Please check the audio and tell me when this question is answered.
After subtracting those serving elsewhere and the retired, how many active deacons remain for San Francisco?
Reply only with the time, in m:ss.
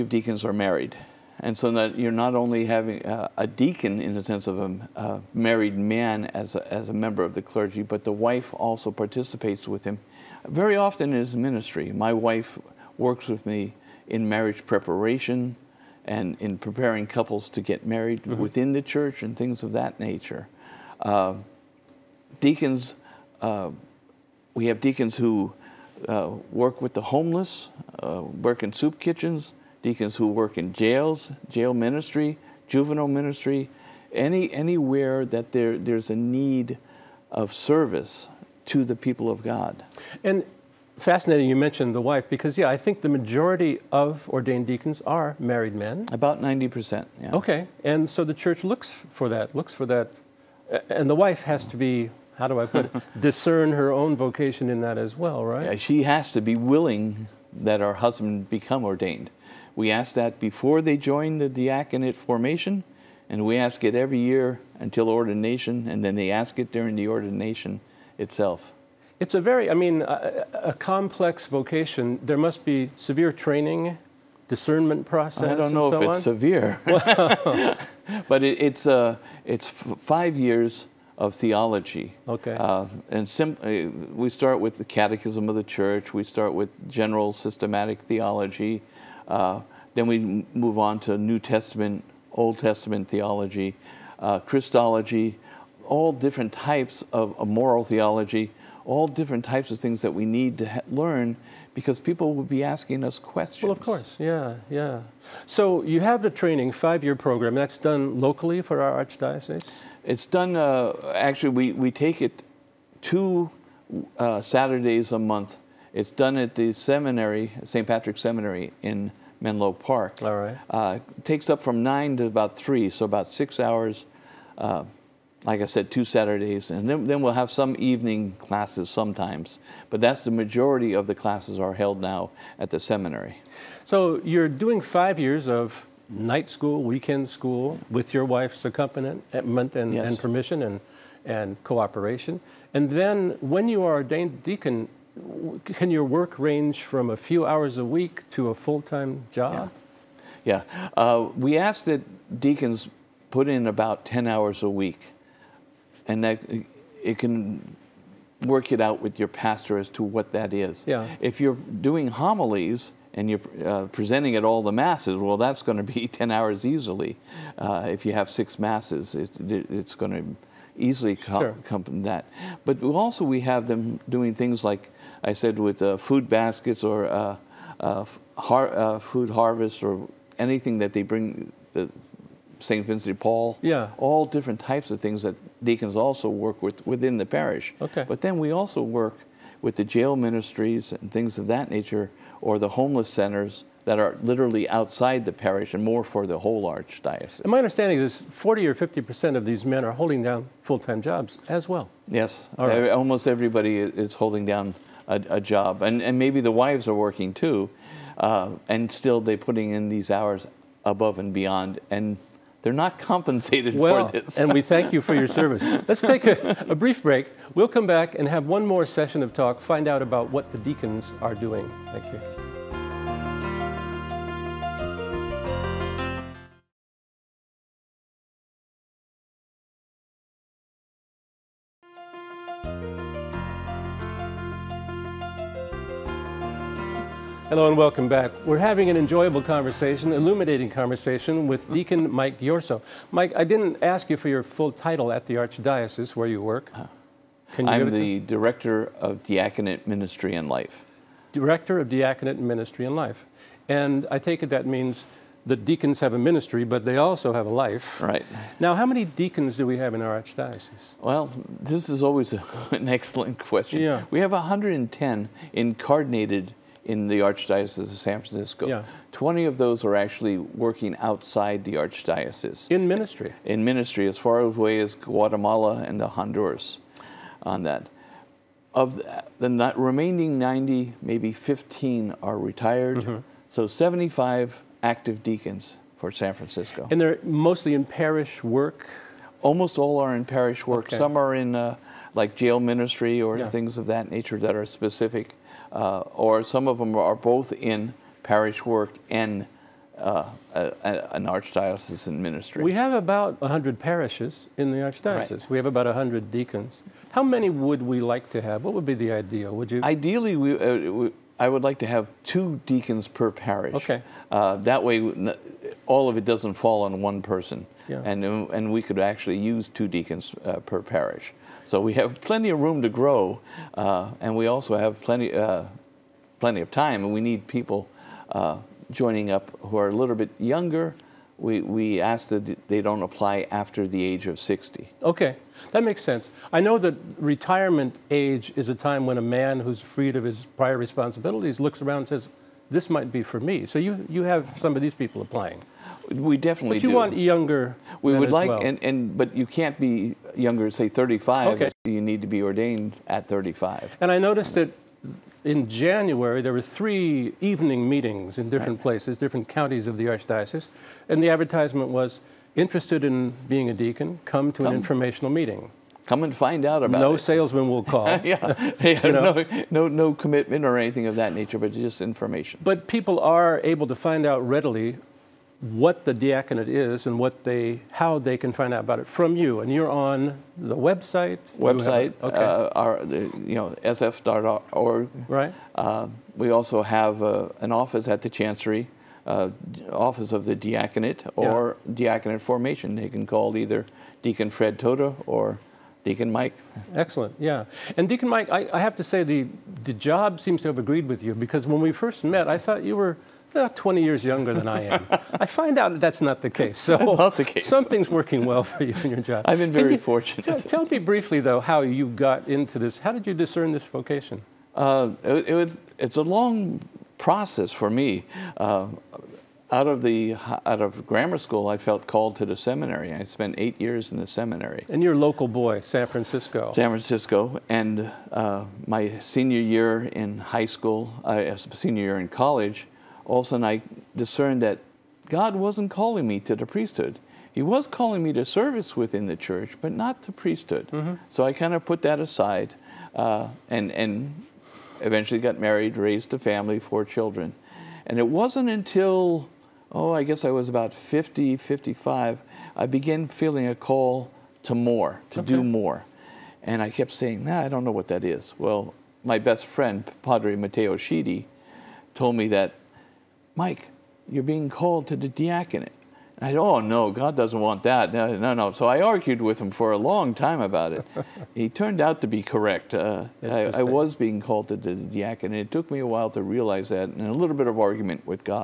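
4:43.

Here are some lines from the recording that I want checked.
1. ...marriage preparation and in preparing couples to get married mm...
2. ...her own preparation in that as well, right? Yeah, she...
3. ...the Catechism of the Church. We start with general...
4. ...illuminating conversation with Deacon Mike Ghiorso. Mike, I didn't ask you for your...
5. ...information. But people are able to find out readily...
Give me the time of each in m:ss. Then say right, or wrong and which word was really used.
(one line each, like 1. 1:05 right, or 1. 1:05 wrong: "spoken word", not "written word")
1. 0:14 right
2. 0:53 wrong: "vocation", not "preparation"
3. 1:24 right
4. 4:00 right
5. 6:12 right.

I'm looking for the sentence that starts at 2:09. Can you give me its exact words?
But that's the majority of the classes are held now at the seminary.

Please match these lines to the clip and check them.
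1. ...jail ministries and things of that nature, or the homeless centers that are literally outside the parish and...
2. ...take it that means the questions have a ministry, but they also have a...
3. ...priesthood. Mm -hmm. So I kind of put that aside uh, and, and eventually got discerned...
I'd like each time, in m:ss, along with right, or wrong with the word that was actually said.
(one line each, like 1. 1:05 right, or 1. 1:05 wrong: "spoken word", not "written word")
1. 3:09 right
2. 4:14 wrong: "deacons", not "questions"
3. 7:20 wrong: "married", not "discerned".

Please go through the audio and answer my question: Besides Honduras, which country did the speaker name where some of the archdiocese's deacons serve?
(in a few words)
Guatemala.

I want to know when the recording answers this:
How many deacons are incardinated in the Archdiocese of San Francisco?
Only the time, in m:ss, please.
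4:24.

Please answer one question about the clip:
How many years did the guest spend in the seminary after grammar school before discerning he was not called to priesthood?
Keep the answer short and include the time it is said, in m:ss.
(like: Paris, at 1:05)
8 years, at 7:03.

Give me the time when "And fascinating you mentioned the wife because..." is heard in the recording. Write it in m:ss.
0:40.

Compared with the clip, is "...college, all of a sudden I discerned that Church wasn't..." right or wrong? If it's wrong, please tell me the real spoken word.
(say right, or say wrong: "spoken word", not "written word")
wrong: "God", not "Church".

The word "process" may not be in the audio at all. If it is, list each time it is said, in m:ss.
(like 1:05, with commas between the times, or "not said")
1:15, 6:57.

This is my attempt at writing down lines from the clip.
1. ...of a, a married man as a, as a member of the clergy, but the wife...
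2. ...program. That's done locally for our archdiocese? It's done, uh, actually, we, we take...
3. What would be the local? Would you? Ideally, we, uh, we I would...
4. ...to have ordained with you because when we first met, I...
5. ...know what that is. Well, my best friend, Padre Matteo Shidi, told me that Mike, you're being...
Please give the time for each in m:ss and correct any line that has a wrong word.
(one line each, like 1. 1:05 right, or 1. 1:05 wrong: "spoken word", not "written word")
1. 0:04 right
2. 1:47 right
3. 5:08 wrong: "ideal", not "local"
4. 6:40 wrong: "agreed", not "ordained"
5. 7:37 right.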